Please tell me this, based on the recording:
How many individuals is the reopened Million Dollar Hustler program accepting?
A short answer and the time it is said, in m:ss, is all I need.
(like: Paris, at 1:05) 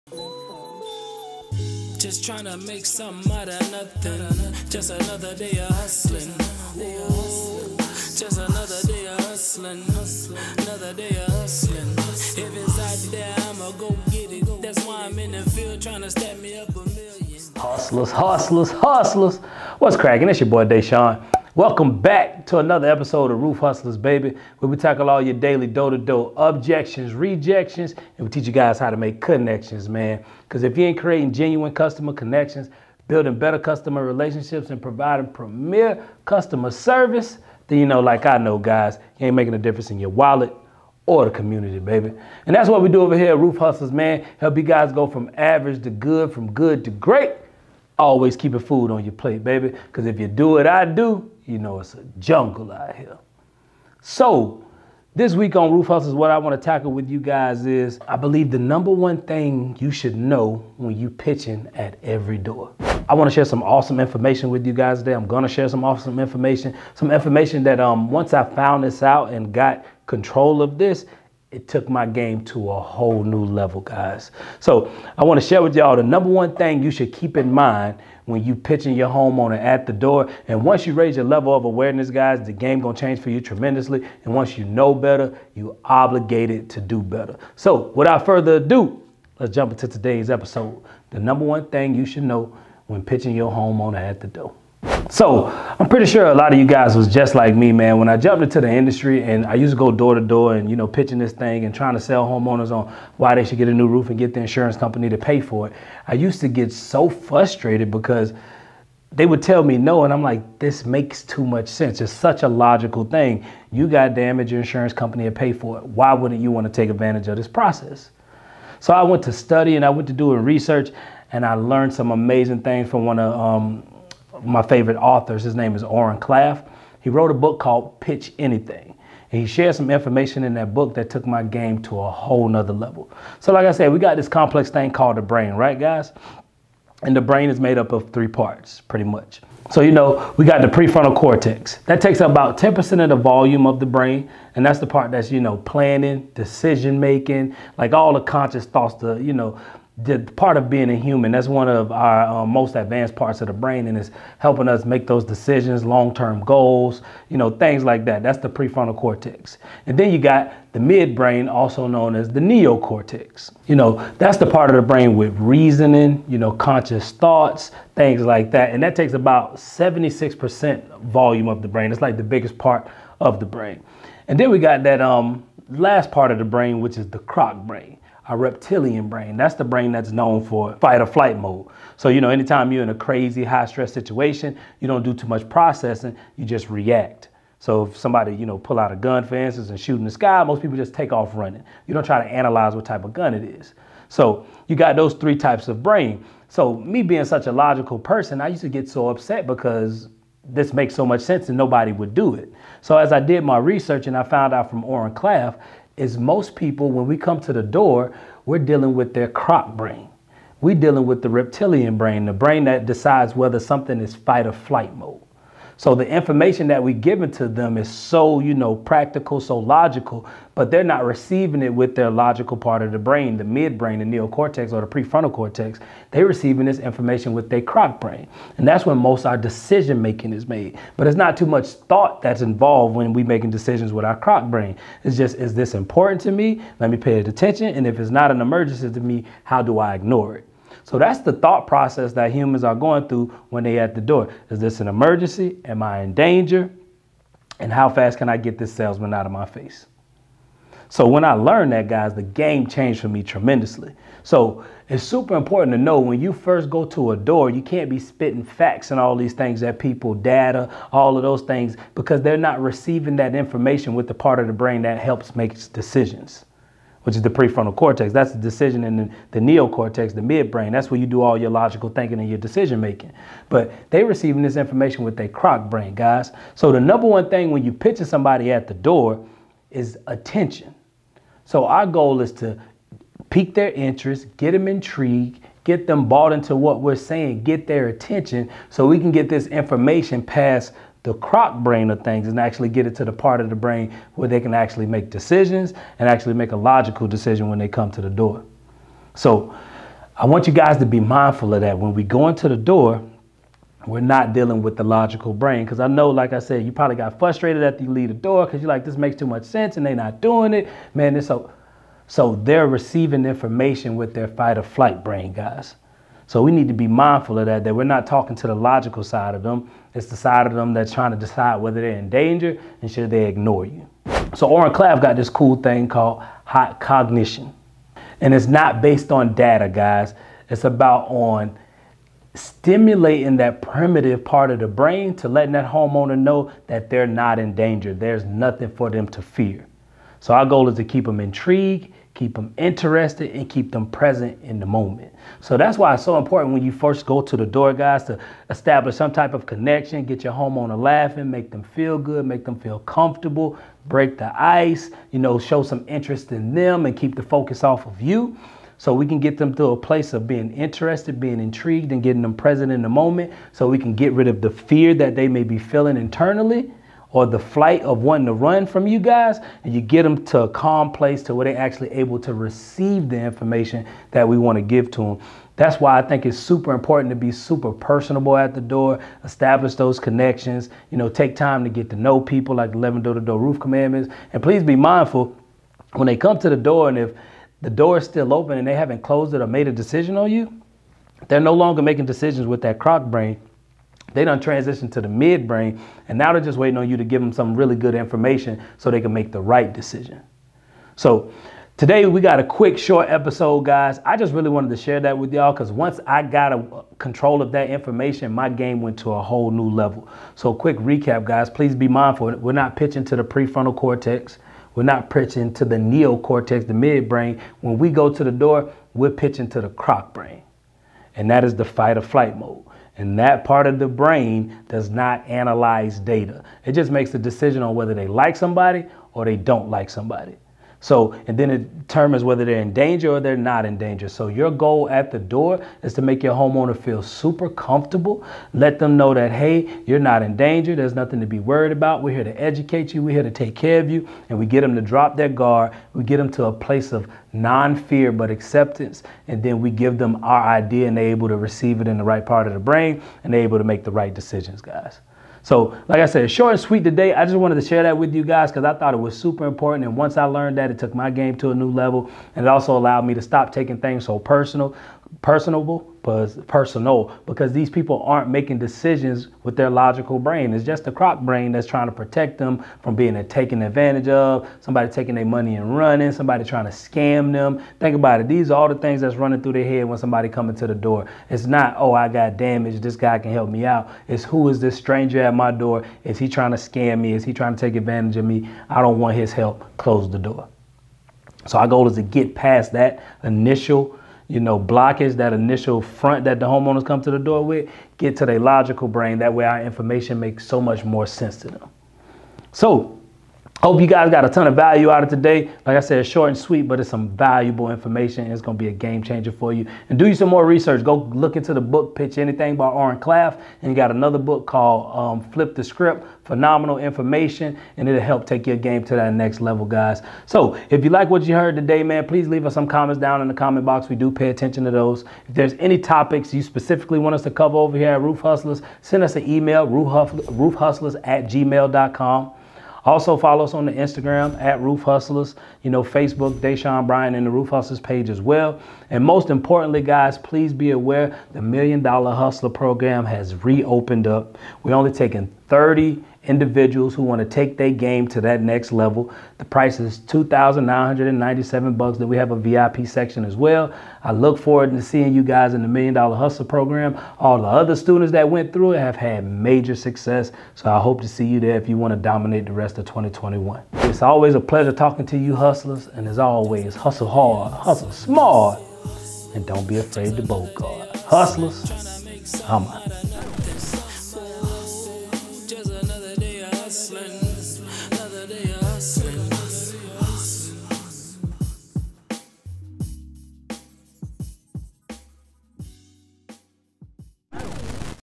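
30, at 9:05.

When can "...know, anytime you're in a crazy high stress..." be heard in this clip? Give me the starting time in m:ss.
3:02.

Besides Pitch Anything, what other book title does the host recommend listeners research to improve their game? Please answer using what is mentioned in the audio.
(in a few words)
Flip the Script.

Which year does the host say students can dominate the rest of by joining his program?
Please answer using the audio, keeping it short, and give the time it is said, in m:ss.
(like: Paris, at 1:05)
2021, at 9:22.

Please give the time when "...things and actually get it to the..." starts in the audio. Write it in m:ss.
4:52.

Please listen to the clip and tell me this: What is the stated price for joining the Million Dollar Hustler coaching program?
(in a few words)
$2,997.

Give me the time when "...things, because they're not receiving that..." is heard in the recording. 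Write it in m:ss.
4:21.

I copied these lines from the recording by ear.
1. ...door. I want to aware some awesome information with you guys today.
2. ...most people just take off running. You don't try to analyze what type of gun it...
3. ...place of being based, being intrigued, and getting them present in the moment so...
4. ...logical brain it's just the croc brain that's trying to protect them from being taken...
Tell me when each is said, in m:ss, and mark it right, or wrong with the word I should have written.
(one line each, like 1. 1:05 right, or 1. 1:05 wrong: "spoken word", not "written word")
1. 1:02 wrong: "share", not "aware"
2. 3:10 right
3. 5:59 wrong: "interested", not "based"
4. 7:49 right.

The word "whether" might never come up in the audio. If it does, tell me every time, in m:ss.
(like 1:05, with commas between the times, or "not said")
3:33, 5:21, 7:07, 7:12.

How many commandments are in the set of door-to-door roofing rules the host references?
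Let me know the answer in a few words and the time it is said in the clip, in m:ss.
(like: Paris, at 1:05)
11, at 6:22.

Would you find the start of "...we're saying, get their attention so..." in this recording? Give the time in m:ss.
4:46.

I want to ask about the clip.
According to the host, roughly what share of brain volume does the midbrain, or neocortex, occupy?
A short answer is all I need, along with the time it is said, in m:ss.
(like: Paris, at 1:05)
76%, at 2:49.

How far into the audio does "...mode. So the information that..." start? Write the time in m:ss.
3:34.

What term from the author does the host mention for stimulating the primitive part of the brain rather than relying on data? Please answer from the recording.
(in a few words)
hot cognition.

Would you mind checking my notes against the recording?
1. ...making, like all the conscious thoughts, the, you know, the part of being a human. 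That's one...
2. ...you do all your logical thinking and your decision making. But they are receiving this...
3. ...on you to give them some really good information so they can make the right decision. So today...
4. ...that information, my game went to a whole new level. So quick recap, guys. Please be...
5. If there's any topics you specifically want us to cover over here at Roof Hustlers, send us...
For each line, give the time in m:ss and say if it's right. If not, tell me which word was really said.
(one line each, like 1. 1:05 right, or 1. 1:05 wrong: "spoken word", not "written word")
1. 2:26 right
2. 4:30 right
3. 6:36 right
4. 6:47 right
5. 8:45 right.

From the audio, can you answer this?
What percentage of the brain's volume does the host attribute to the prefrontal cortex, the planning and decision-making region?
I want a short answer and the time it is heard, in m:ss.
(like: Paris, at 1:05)
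10%, at 2:22.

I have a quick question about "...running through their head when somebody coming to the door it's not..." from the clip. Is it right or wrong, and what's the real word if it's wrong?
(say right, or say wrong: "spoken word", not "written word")
right.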